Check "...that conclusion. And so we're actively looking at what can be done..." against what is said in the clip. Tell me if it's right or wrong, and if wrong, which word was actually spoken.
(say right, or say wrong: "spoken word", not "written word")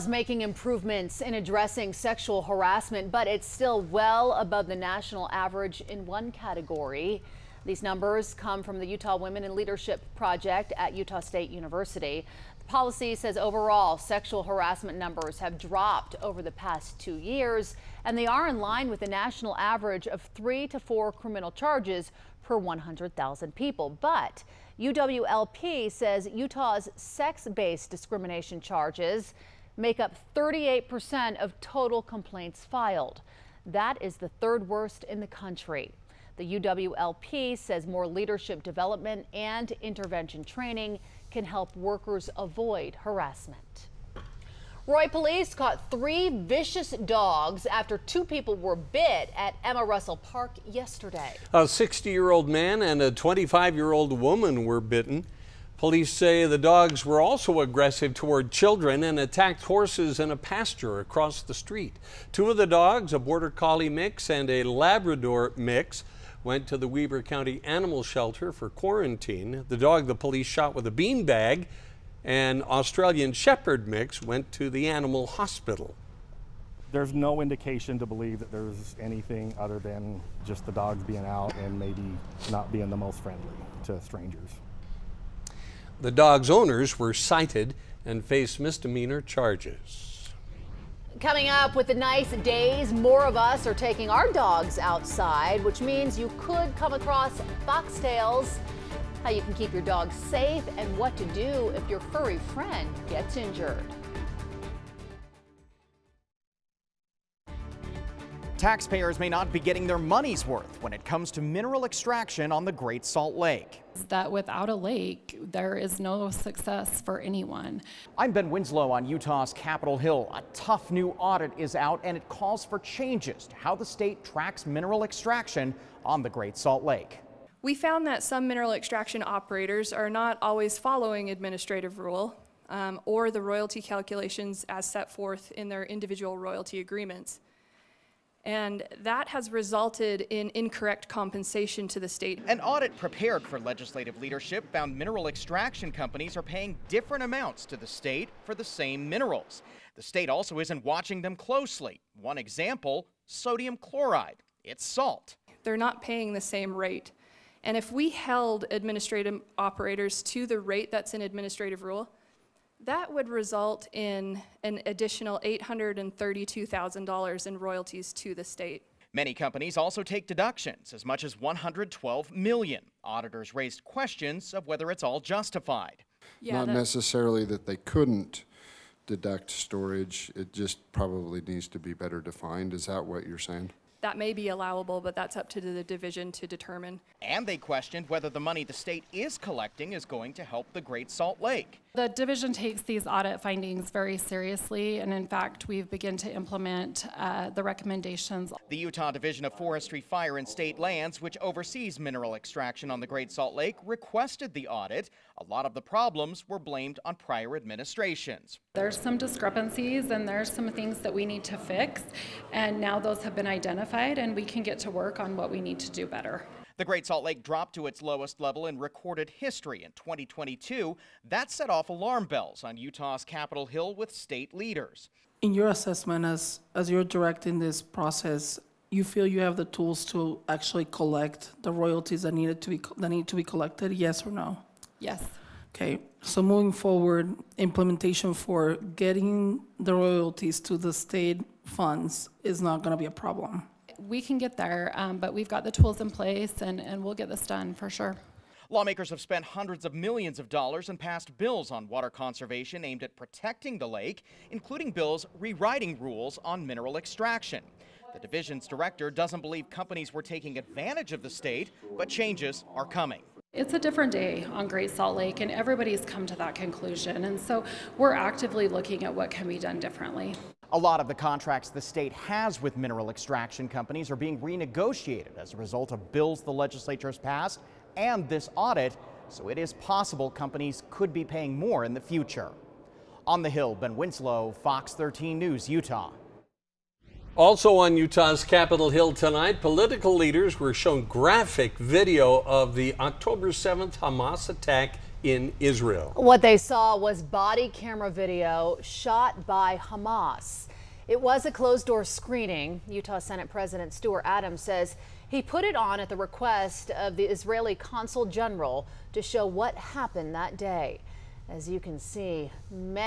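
right.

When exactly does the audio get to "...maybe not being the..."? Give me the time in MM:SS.
01:21.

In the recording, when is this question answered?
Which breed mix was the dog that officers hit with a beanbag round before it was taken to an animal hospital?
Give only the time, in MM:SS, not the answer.
01:12.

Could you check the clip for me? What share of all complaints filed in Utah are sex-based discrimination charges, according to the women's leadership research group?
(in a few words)
38%.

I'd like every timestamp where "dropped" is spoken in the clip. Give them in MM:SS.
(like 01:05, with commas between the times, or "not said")
00:15, 03:37.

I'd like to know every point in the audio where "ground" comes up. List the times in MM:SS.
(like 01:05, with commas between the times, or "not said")
not said.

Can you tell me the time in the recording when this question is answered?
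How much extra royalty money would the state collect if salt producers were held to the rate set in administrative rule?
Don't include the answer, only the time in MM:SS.
02:45.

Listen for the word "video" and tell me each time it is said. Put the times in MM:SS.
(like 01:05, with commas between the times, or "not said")
04:51, 04:58.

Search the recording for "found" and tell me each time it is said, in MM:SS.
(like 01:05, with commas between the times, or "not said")
02:07, 02:24.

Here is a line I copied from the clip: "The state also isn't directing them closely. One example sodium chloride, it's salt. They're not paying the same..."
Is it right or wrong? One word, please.
wrong.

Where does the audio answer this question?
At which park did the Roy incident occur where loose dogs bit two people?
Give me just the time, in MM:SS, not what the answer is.
00:49.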